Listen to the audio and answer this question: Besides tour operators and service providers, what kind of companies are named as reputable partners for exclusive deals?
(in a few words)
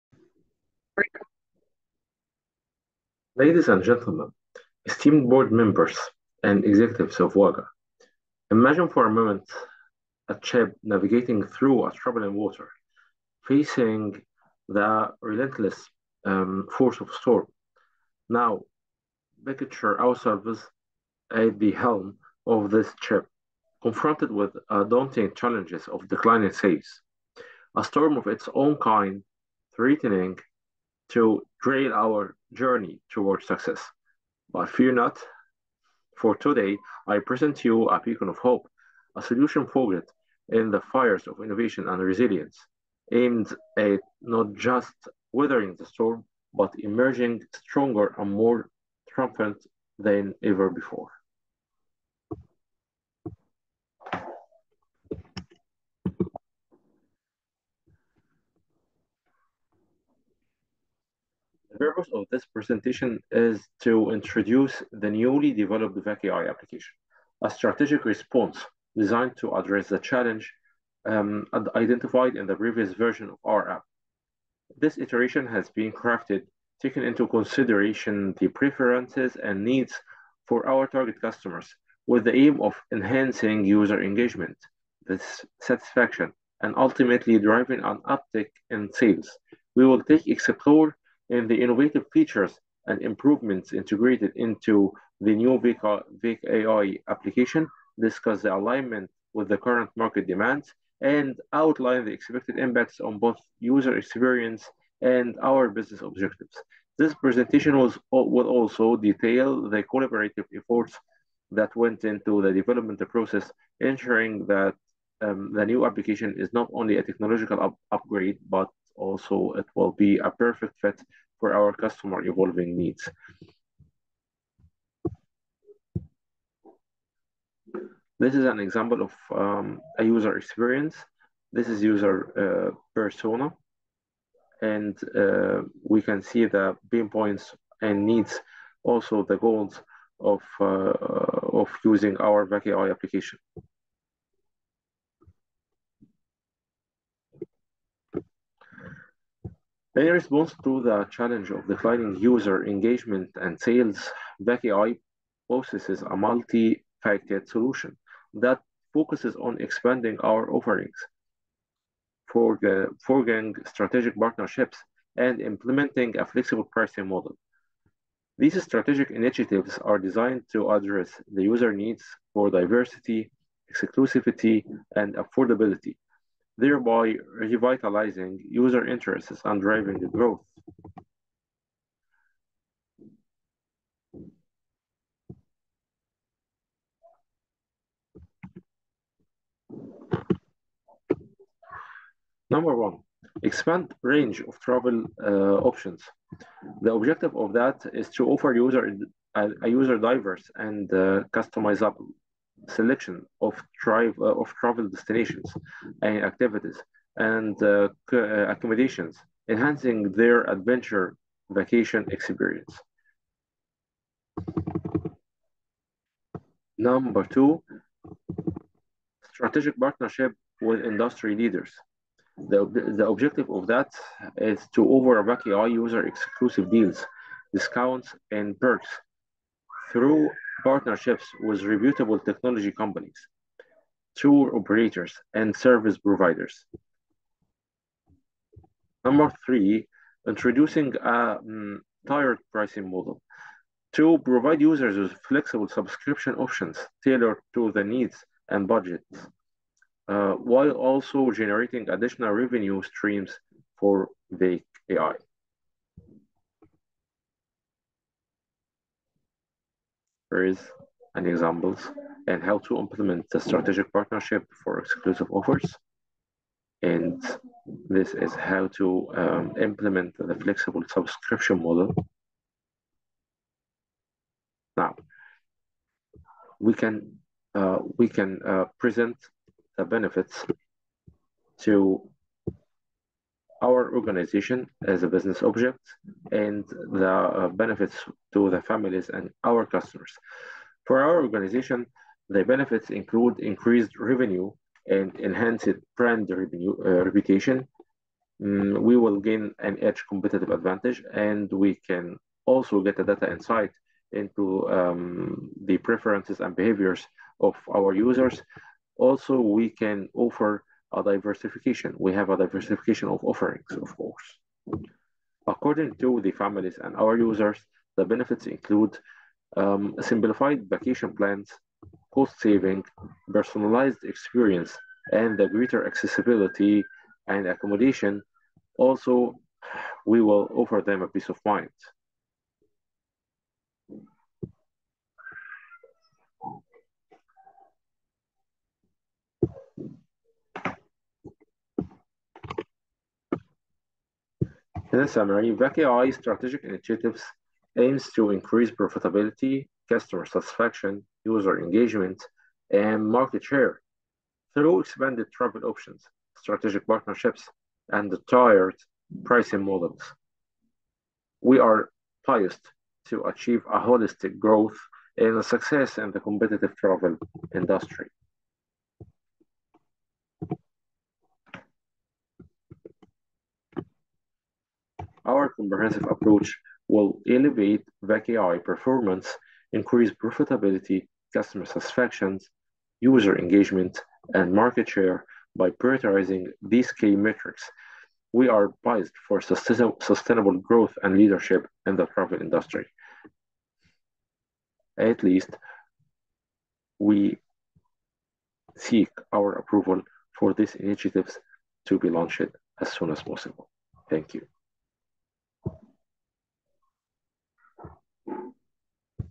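technology companies.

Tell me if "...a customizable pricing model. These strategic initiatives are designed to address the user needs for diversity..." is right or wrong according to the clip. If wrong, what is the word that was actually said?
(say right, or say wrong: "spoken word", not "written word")
wrong: "flexible", not "customizable".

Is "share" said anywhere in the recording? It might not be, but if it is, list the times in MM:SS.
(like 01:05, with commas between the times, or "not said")
05:53, 06:24.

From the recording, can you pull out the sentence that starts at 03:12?
Number one, expand range of travel uh, options.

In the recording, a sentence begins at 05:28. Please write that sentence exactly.
Also, we will offer them a peace of mind.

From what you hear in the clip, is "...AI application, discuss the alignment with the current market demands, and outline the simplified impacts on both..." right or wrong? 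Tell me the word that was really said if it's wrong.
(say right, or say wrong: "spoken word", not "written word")
wrong: "expected", not "simplified".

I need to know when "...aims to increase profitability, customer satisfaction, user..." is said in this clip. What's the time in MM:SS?
05:47.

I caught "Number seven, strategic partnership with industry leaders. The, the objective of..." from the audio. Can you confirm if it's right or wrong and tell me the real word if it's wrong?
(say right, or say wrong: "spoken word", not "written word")
wrong: "two", not "seven".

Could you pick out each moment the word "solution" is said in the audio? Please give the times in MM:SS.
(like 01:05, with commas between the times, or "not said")
00:39, 02:37.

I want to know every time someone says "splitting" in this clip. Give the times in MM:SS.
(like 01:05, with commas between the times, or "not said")
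not said.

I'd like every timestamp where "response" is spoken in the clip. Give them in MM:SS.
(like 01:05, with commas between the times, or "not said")
01:08, 02:30.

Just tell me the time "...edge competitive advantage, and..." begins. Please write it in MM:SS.
04:59.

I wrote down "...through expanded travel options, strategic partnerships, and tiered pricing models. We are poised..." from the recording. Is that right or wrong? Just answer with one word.
right.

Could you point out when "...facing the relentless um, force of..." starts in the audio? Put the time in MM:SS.
00:13.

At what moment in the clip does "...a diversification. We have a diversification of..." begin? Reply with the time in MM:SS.
05:10.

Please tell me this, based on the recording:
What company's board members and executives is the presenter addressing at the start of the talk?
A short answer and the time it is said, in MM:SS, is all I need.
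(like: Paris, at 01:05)
Waga, at 00:07.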